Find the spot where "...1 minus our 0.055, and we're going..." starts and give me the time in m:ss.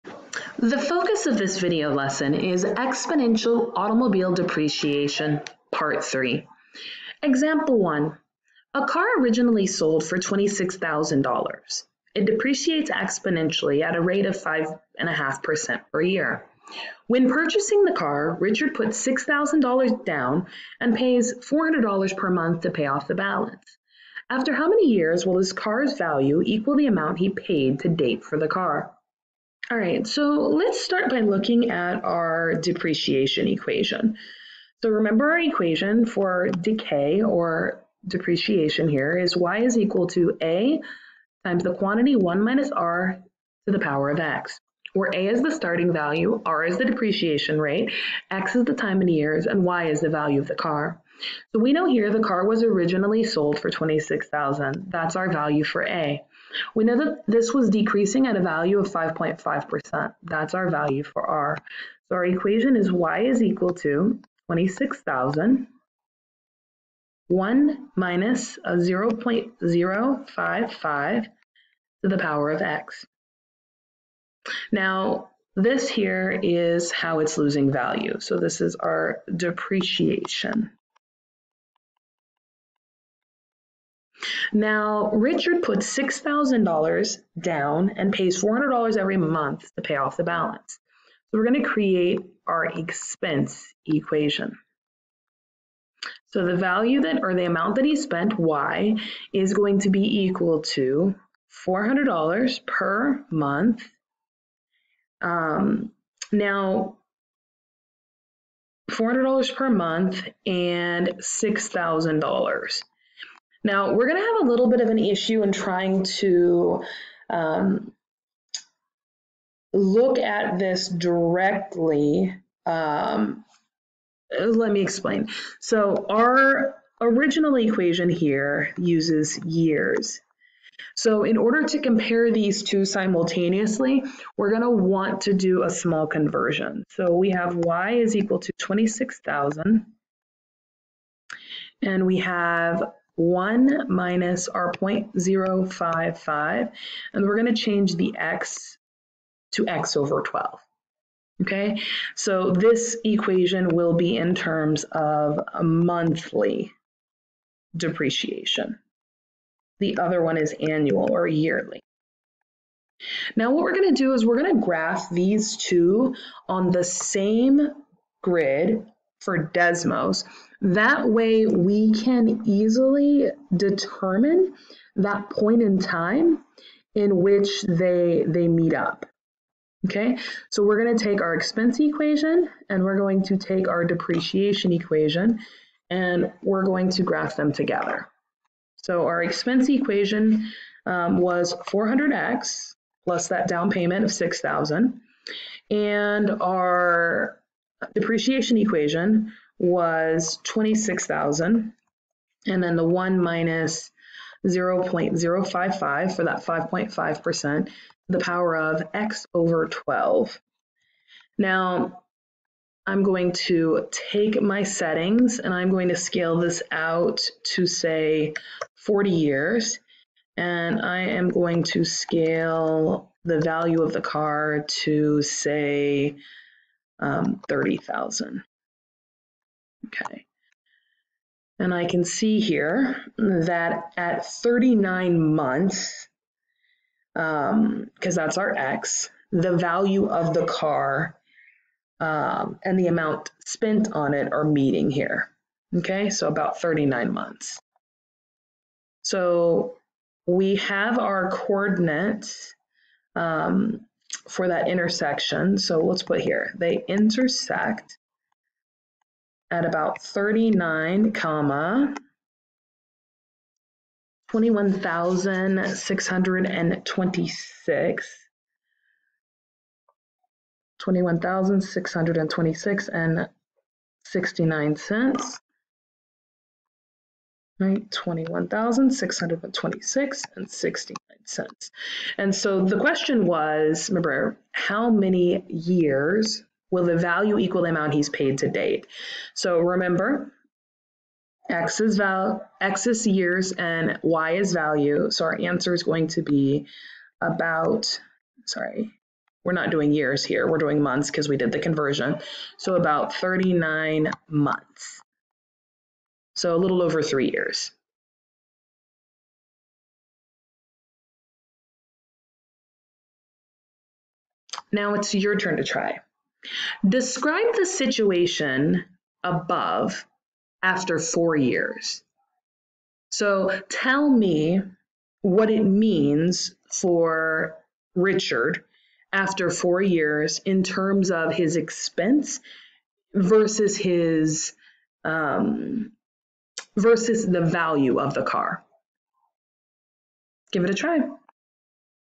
2:23.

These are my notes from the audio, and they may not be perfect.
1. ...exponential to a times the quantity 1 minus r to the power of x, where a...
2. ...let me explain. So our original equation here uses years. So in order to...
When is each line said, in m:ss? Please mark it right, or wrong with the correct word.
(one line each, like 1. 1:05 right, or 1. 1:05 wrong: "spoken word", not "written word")
1. 0:39 wrong: "equal", not "exponential"
2. 2:04 right.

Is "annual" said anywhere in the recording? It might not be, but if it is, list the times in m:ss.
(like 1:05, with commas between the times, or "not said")
2:40.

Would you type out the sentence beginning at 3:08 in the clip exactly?
So our expense equation um, was 400x plus that down payment of 6,000 and our depreciation equation was 26,000.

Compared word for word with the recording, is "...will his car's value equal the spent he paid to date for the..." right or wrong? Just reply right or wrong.
wrong.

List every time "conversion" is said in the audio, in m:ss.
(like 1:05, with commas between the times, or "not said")
2:16, 5:01.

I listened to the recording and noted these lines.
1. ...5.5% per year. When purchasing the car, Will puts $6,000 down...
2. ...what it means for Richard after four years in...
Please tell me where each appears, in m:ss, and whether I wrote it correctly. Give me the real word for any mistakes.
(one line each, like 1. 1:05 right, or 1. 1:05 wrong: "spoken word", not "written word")
1. 0:14 wrong: "Richard", not "Will"
2. 5:25 right.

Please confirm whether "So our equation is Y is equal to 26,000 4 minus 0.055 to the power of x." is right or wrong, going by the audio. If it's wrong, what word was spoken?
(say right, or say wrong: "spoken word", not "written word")
wrong: "1", not "4".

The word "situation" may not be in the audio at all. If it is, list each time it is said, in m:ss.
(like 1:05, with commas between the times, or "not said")
5:17.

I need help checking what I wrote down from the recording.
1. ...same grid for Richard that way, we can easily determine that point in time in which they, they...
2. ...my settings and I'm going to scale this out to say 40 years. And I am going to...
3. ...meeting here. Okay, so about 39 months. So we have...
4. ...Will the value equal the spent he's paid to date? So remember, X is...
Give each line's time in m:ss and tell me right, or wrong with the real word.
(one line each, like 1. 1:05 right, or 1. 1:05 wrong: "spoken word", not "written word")
1. 2:46 wrong: "Desmos", not "Richard"
2. 3:34 right
3. 4:04 right
4. 4:46 wrong: "amount", not "spent".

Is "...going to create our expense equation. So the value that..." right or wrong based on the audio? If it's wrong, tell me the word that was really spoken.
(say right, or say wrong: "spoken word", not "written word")
right.